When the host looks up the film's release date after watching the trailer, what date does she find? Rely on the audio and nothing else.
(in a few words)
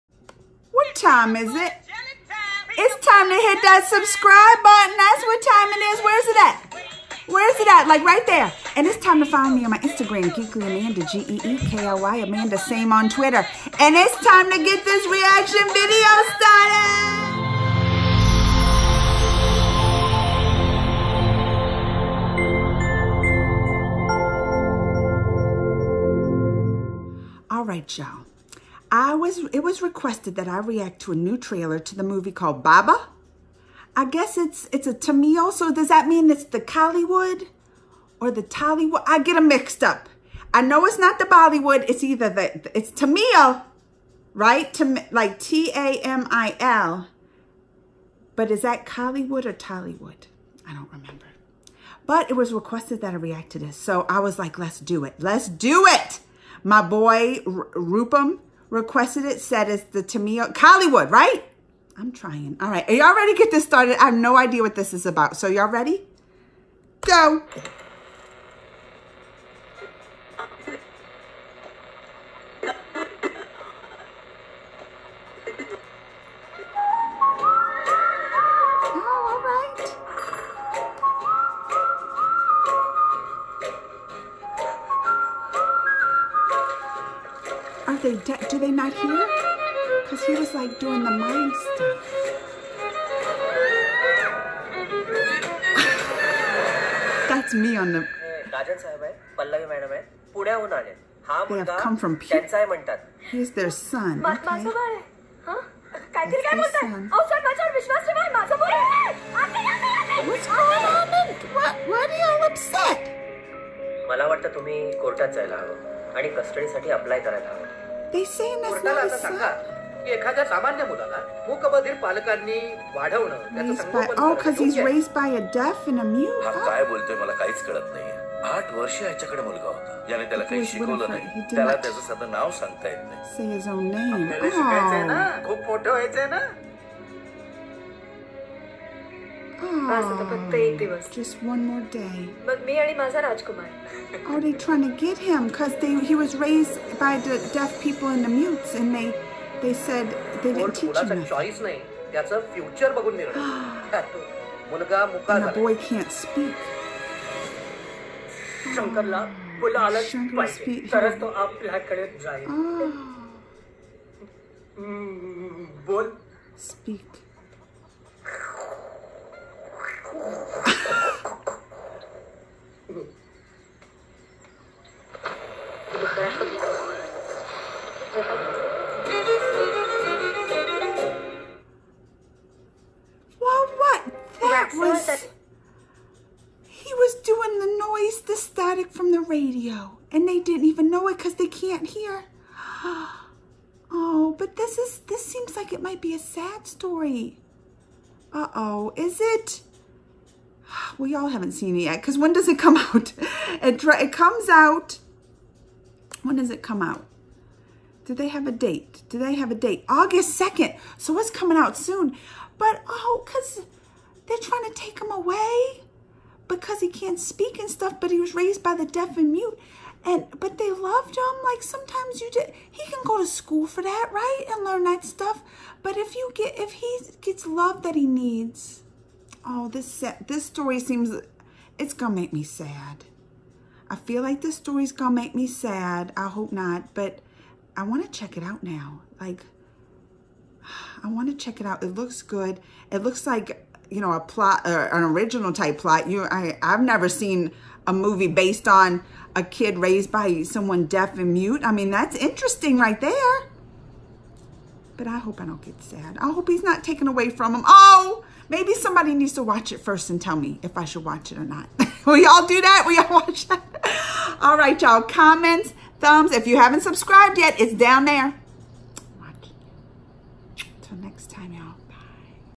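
August 2nd.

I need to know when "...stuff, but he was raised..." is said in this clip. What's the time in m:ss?
3:37.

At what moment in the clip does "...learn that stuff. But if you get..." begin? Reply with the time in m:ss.
3:44.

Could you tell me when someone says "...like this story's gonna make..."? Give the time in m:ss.
3:54.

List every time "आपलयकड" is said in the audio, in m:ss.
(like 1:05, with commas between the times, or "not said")
2:41.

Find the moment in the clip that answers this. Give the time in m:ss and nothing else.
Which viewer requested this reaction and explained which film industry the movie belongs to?
0:57.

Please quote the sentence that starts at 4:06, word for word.
You, I, I've never seen a movie based on a kid raised by someone deaf and mute.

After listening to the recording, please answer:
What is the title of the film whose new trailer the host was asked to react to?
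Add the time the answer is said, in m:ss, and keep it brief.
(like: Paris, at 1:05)
Baba, at 0:32.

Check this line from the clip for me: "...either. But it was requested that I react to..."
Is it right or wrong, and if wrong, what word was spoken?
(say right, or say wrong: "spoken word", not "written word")
wrong: "remember", not "either".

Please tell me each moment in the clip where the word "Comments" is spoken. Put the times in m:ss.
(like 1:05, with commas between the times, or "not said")
4:25.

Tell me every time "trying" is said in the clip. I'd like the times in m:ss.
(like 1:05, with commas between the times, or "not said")
1:02, 2:24.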